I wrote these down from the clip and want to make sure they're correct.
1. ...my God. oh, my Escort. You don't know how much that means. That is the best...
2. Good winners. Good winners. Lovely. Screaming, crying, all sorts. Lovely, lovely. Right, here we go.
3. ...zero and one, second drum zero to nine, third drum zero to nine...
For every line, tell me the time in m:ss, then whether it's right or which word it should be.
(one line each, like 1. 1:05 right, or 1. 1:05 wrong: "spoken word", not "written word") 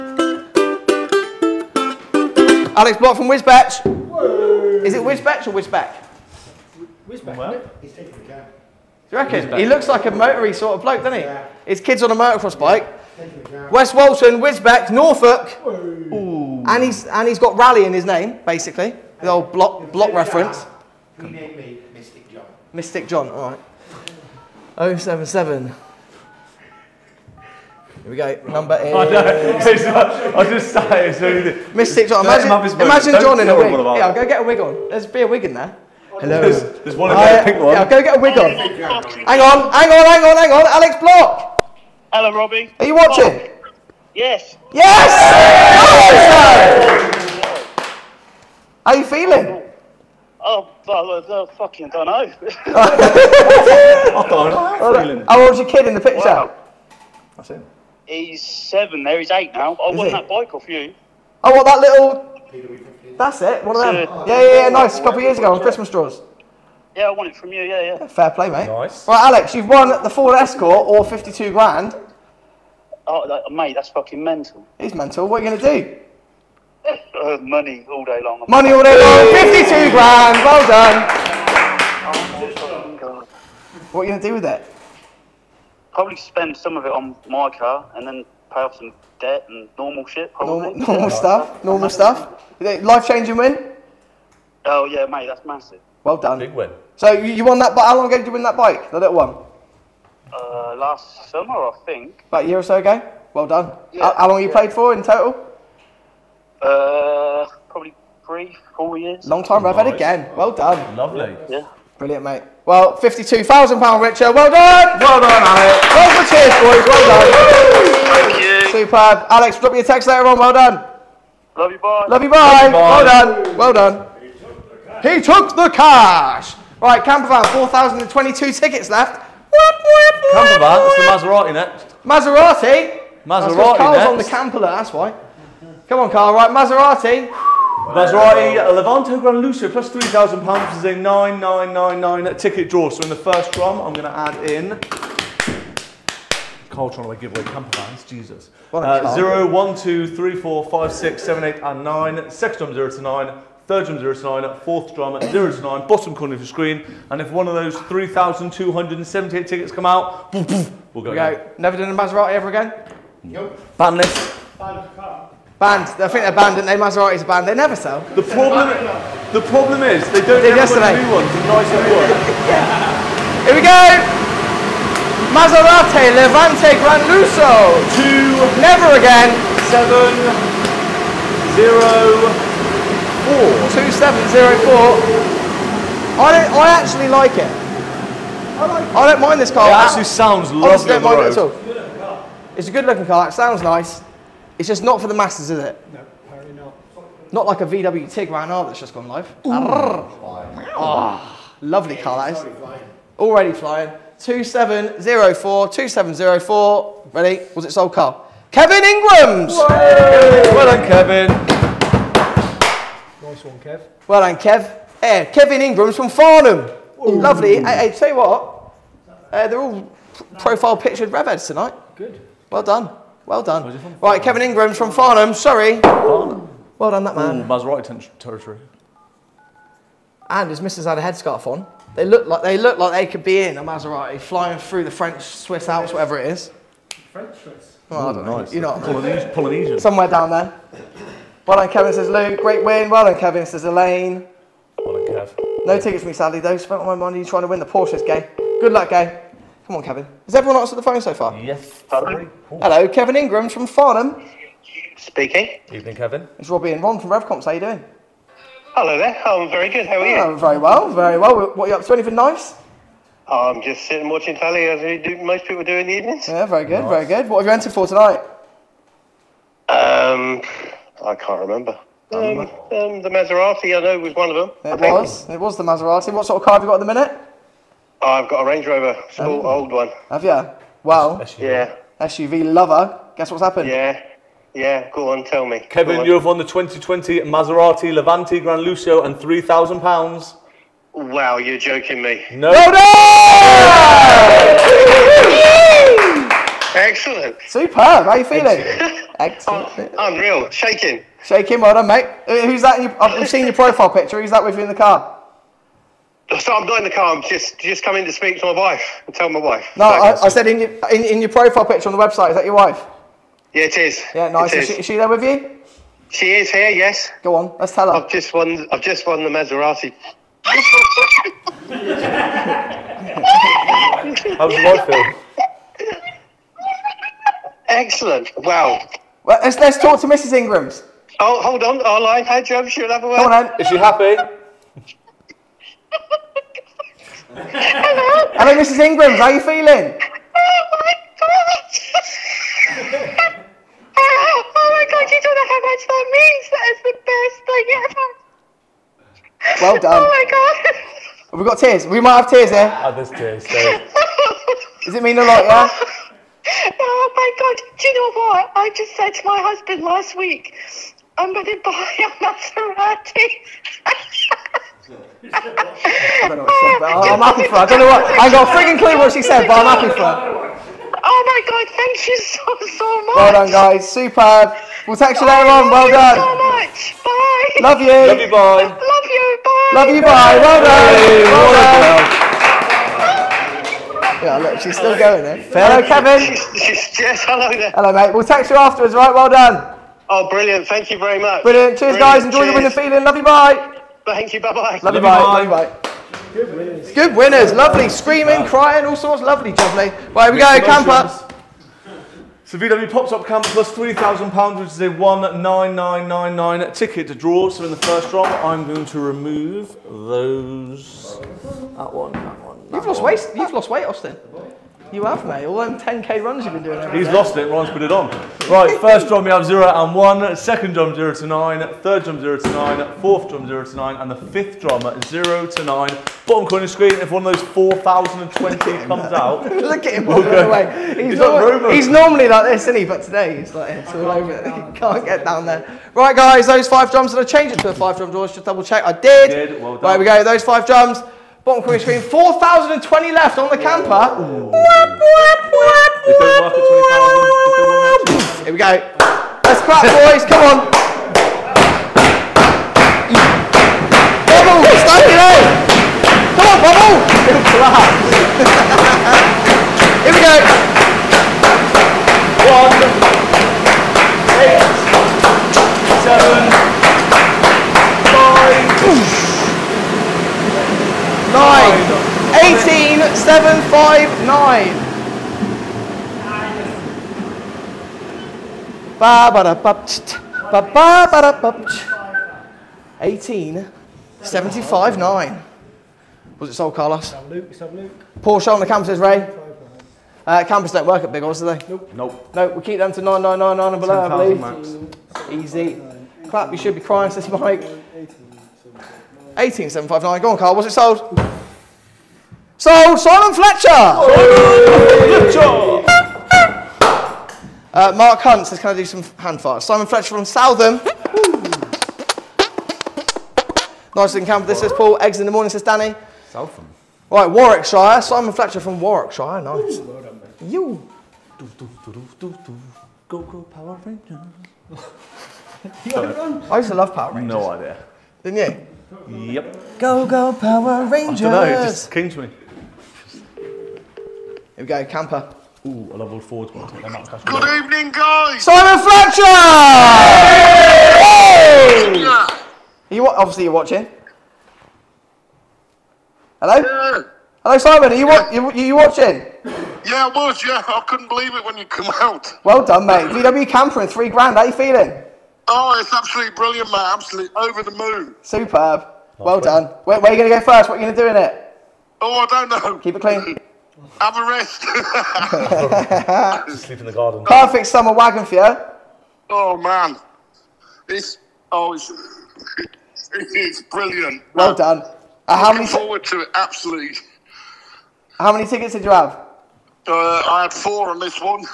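1. 5:40 wrong: "God", not "Escort"
2. 6:36 right
3. 6:59 right.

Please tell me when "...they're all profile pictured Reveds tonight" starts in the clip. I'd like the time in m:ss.
3:39.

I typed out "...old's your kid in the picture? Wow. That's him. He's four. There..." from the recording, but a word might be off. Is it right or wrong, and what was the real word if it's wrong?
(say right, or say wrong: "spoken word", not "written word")
wrong: "seven", not "four".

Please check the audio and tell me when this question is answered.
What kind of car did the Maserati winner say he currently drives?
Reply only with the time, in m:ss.
4:38.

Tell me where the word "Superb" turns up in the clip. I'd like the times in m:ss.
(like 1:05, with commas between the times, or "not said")
1:58, 4:57, 6:13, 9:18.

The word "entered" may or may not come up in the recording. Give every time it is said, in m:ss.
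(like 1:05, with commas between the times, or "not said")
4:27.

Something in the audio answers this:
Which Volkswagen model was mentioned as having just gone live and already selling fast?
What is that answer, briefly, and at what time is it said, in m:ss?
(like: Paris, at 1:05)
VW Tiguan R, at 3:17.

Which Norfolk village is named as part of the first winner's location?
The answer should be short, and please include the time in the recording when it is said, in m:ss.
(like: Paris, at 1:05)
West Walton, at 0:13.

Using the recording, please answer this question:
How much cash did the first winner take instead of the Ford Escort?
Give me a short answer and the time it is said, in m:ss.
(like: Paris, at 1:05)
52 grand, at 1:10.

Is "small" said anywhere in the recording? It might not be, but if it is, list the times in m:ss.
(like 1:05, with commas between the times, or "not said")
4:39.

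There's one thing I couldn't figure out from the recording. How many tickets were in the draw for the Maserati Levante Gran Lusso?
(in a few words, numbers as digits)
9999.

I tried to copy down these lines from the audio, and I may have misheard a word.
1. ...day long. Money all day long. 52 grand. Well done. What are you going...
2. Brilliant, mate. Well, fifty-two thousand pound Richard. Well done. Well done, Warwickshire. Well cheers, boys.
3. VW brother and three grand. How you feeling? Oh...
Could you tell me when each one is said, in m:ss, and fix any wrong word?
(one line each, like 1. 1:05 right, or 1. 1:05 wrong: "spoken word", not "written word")
1. 1:18 right
2. 1:51 wrong: "Alex", not "Warwickshire"
3. 9:13 wrong: "camper", not "brother".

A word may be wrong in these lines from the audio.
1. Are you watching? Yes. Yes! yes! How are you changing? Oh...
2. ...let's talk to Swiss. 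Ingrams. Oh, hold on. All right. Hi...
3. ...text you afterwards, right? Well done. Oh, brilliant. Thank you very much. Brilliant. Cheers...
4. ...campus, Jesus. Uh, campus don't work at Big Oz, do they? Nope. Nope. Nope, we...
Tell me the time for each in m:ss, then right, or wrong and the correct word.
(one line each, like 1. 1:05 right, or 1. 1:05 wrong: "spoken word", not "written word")
1. 0:42 wrong: "feeling", not "changing"
2. 5:29 wrong: "Mrs", not "Swiss"
3. 6:28 right
4. 8:08 wrong: "Ray", not "Jesus".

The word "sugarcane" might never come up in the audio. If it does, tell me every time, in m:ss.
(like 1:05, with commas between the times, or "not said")
not said.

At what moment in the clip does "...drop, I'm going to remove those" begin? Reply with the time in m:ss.
6:48.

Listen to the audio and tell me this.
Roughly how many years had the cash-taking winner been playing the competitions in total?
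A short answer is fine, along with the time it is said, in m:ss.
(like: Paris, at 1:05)
three, four years, at 1:47.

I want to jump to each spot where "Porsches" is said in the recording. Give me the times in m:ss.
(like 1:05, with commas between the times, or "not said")
4:07.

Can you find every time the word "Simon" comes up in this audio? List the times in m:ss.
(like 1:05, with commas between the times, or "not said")
8:22, 8:29, 8:38, 8:58, 9:07.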